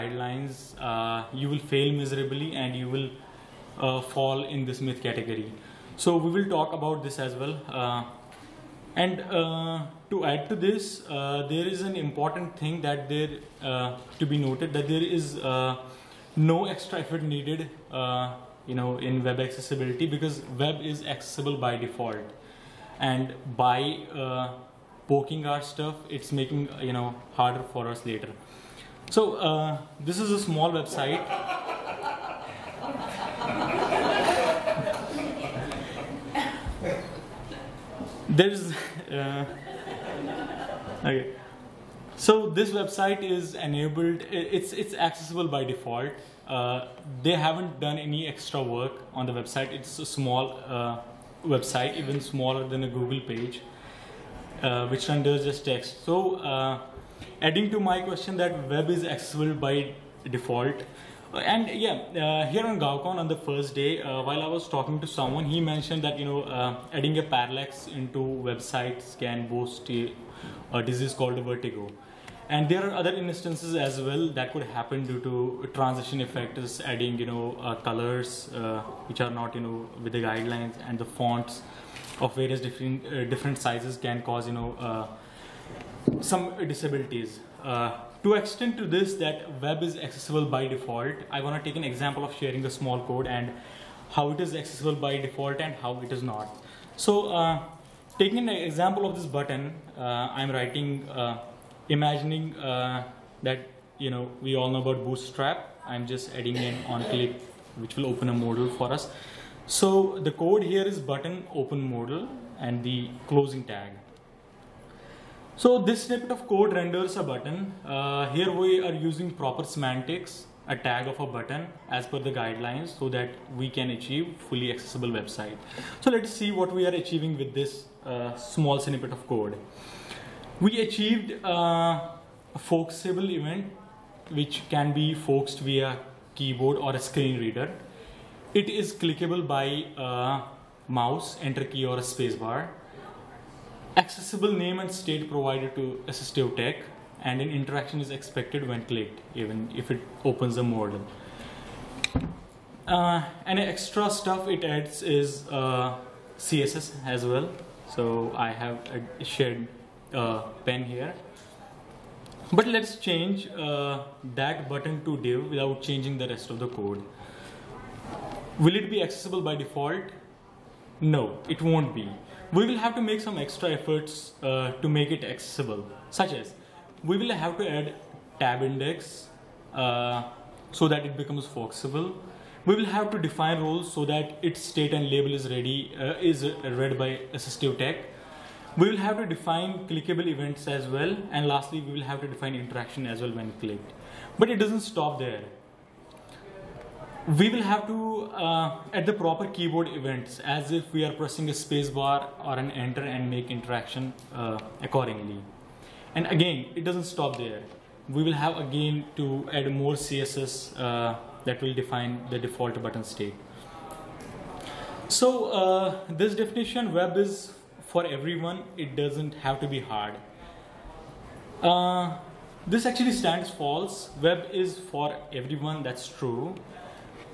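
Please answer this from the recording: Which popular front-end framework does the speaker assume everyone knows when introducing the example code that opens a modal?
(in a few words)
Bootstrap.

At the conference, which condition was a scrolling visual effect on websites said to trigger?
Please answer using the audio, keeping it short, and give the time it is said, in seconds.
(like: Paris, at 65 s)
vertigo, at 71 s.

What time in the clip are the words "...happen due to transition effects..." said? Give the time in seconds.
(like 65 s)
74 s.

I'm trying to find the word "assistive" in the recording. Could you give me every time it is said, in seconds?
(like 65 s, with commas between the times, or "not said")
146 s, 187 s.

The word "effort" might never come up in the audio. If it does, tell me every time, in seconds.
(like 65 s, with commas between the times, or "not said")
16 s, 173 s.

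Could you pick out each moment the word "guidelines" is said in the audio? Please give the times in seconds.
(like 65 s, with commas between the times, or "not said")
80 s, 122 s.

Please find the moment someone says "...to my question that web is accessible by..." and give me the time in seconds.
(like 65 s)
57 s.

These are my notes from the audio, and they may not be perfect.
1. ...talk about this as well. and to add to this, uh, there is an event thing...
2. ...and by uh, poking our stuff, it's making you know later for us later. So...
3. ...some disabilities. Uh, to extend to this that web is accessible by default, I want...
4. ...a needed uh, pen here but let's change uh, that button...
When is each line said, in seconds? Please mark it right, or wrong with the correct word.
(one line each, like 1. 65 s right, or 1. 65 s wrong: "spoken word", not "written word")
1. 6 s wrong: "important", not "event"
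2. 22 s wrong: "harder", not "later"
3. 86 s right
4. 159 s wrong: "shared", not "needed".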